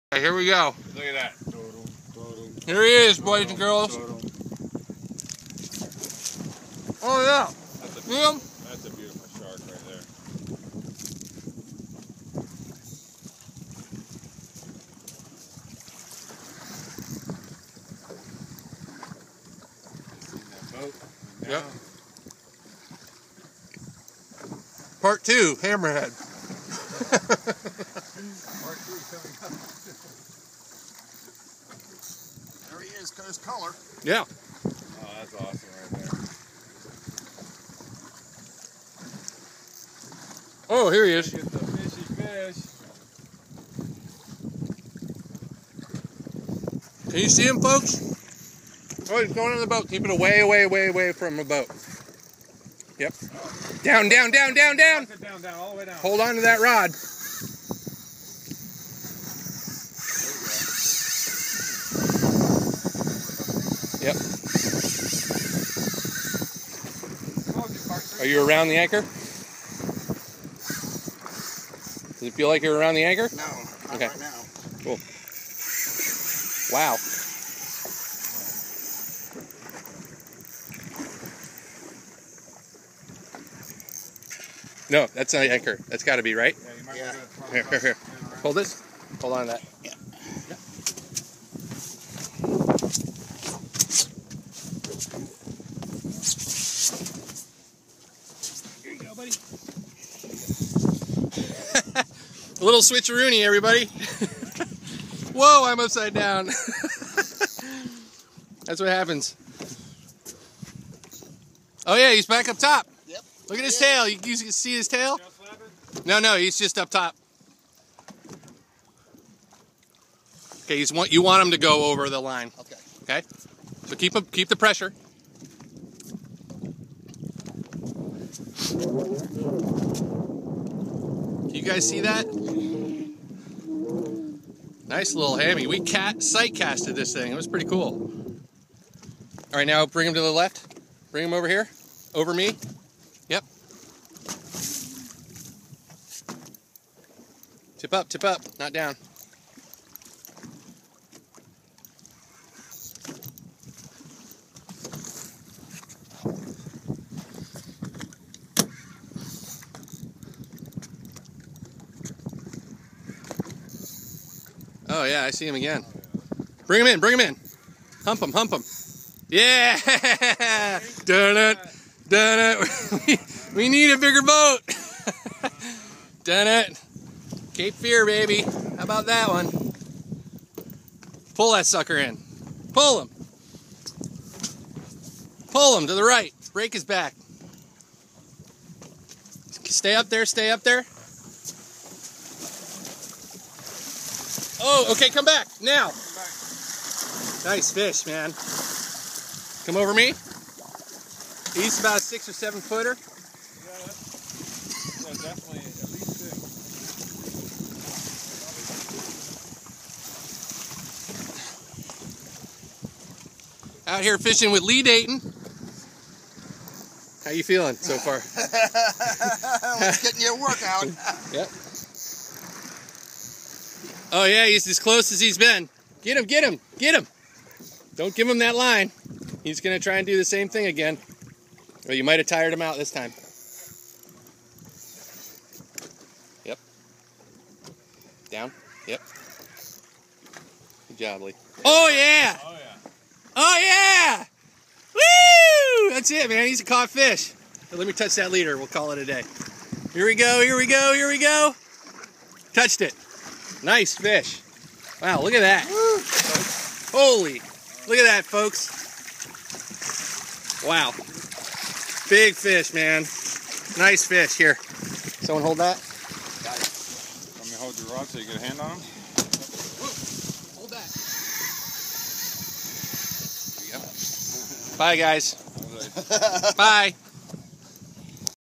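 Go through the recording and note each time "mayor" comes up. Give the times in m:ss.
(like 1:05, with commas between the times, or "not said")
not said.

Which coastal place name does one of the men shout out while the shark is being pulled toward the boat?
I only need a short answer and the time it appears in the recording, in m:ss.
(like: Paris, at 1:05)
Cape Fear, at 2:57.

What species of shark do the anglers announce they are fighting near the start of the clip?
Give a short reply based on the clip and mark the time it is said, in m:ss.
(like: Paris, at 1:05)
Hammerhead, at 0:25.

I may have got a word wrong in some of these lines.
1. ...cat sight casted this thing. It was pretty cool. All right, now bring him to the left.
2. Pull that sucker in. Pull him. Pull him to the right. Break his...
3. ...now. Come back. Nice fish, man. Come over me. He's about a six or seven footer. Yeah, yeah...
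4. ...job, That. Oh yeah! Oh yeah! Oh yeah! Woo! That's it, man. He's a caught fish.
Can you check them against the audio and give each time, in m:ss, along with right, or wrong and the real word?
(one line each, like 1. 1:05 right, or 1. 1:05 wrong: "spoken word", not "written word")
1. 2:15 right
2. 3:01 right
3. 3:15 right
4. 4:00 wrong: "Lee", not "That".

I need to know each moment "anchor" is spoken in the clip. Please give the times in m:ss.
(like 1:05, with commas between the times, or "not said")
1:08, 1:13, 1:25.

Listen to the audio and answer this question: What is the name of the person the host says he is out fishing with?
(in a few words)
Lee Dayton.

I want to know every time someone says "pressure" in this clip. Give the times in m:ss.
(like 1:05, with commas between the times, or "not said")
2:04.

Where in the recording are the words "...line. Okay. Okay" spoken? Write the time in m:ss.
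2:02.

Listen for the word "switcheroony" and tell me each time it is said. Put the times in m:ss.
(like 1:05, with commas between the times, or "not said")
1:42.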